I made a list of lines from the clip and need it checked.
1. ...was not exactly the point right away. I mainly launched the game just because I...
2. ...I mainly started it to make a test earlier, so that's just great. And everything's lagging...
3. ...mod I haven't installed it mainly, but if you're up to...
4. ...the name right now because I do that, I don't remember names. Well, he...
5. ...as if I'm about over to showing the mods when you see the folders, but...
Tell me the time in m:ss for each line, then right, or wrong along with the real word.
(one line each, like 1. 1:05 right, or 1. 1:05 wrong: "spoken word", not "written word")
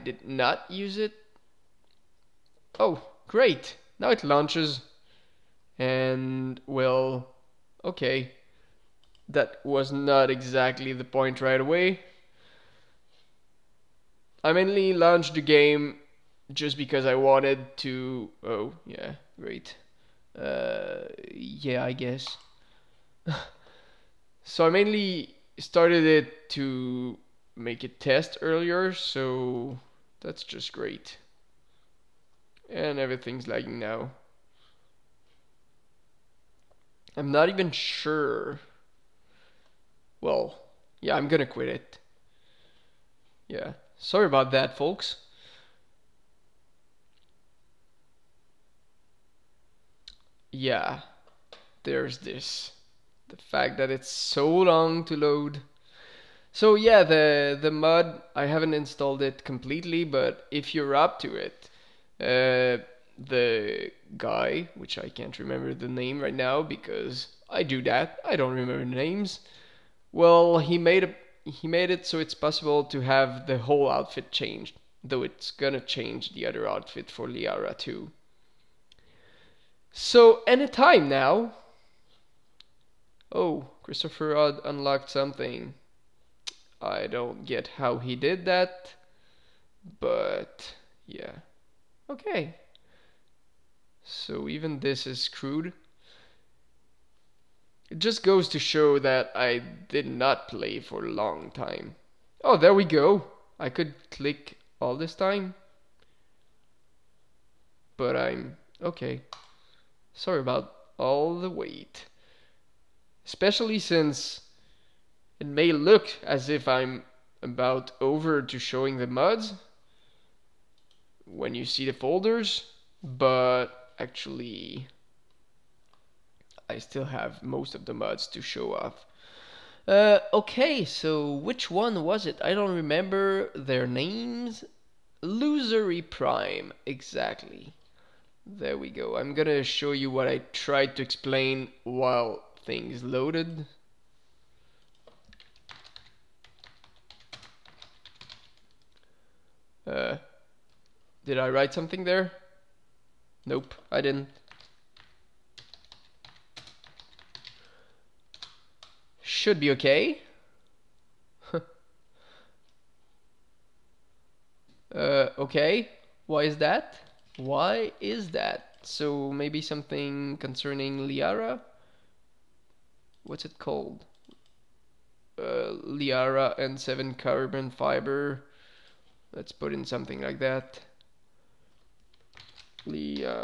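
1. 0:09 right
2. 0:24 right
3. 0:57 wrong: "completely", not "mainly"
4. 1:05 right
5. 1:56 right.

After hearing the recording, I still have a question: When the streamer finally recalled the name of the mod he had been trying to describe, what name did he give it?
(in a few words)
Losery Prime.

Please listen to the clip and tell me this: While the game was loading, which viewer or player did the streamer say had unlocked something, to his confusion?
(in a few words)
Christopher Rudd.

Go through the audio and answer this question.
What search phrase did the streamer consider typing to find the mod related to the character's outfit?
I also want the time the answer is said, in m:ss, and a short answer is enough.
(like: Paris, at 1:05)
Liara N7 carbon fiber, at 2:55.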